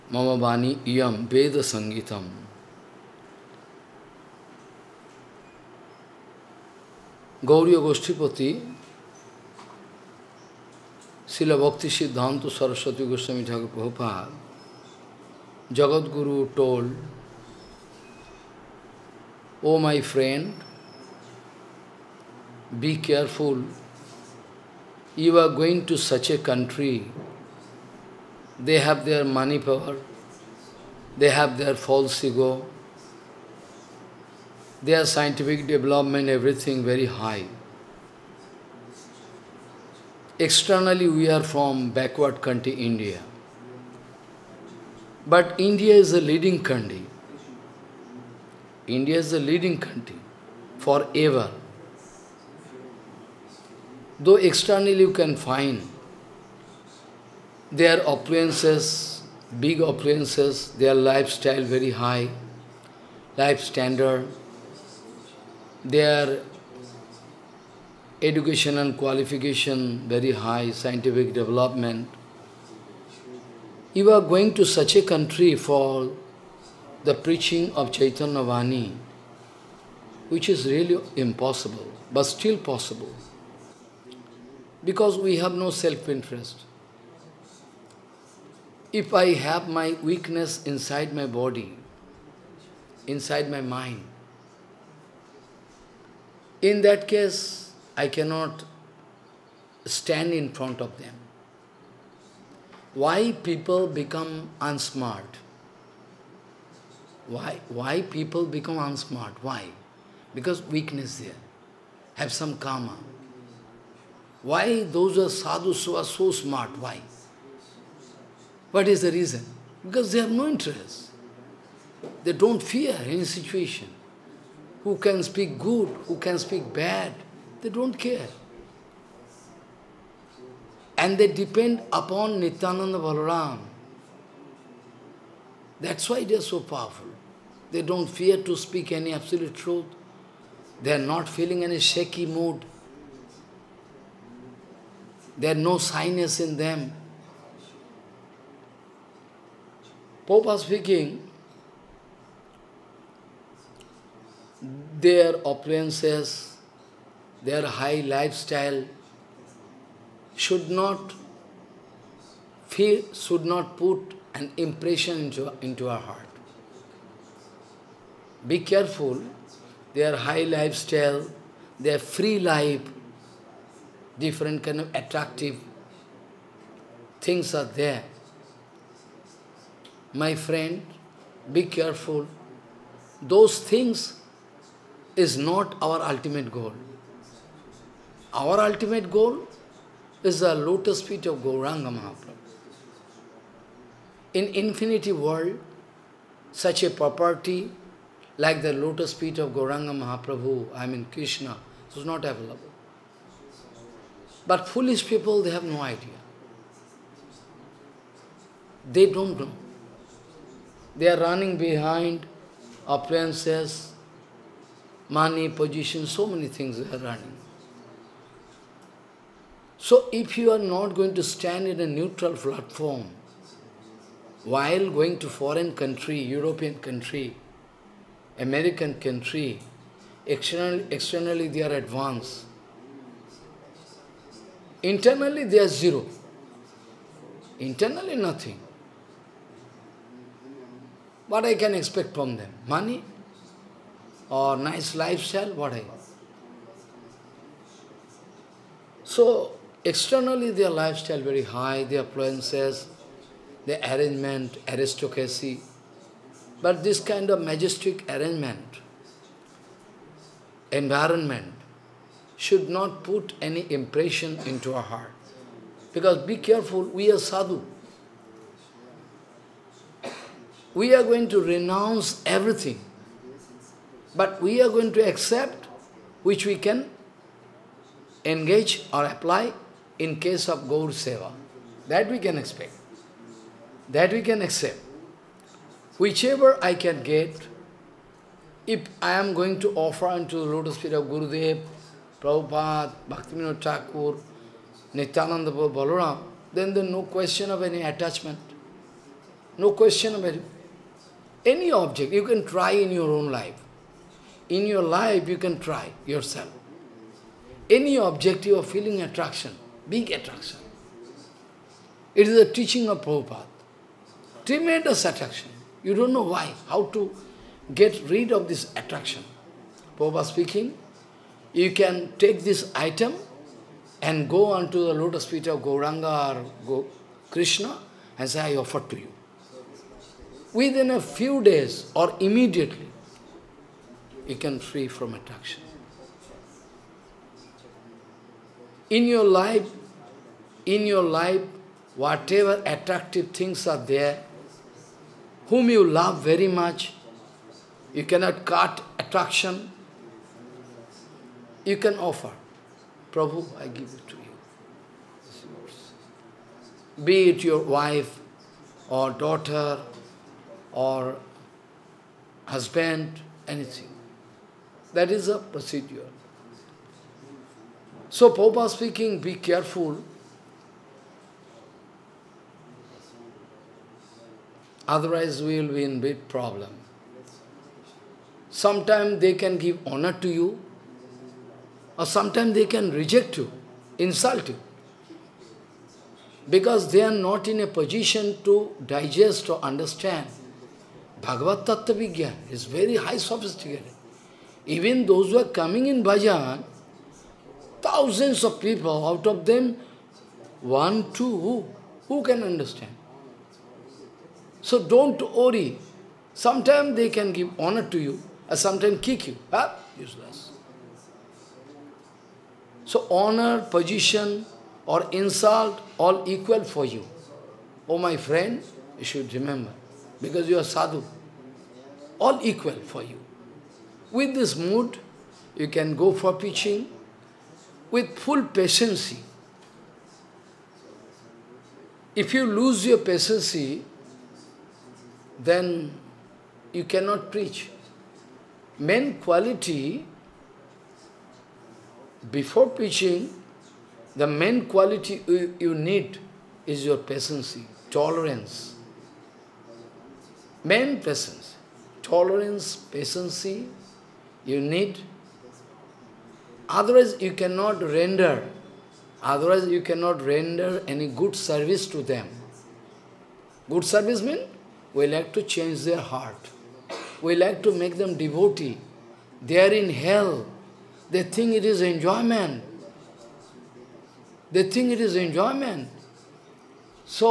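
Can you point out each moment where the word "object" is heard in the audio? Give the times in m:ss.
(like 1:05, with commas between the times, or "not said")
5:01, 5:07.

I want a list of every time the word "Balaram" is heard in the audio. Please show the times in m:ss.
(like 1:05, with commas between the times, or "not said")
2:12, 4:55.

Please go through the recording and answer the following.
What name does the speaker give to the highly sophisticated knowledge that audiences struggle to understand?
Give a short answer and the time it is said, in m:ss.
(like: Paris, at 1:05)
Bhagavad Tattva Vigyan, at 6:31.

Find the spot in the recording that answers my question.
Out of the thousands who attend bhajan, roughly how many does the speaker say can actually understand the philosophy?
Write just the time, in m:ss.
6:40.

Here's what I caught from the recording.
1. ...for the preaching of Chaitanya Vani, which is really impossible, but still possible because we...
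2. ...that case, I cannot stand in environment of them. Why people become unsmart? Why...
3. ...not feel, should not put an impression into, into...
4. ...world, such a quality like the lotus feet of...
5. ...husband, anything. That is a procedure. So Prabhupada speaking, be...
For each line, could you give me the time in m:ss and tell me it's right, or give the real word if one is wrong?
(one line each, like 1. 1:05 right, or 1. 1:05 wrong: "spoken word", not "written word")
1. 1:15 right
2. 1:36 wrong: "front", not "environment"
3. 2:40 right
4. 3:15 wrong: "property", not "quality"
5. 6:02 right.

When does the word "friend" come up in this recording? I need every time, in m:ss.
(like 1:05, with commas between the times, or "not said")
3:00, 6:58.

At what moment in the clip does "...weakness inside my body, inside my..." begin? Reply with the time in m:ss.
1:30.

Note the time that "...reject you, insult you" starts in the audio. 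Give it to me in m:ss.
6:22.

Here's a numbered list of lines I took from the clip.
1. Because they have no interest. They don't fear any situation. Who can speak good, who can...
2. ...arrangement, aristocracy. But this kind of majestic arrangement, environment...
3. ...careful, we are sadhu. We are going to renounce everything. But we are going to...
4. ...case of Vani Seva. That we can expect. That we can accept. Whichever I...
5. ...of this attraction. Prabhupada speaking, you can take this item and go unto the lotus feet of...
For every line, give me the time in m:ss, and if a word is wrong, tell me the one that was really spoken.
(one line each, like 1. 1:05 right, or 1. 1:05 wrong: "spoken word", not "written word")
1. 1:59 right
2. 4:13 right
3. 4:26 right
4. 4:40 wrong: "Gaur", not "Vani"
5. 5:18 right.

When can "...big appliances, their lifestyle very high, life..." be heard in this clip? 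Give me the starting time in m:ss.
0:59.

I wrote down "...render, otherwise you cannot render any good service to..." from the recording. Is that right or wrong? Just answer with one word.
right.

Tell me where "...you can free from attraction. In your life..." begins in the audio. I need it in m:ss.
5:34.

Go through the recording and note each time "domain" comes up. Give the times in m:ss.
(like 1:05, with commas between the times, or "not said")
not said.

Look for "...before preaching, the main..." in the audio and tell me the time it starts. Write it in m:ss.
7:22.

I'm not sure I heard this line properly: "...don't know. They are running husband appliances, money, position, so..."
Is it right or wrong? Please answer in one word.
wrong.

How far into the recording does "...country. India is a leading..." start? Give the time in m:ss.
0:46.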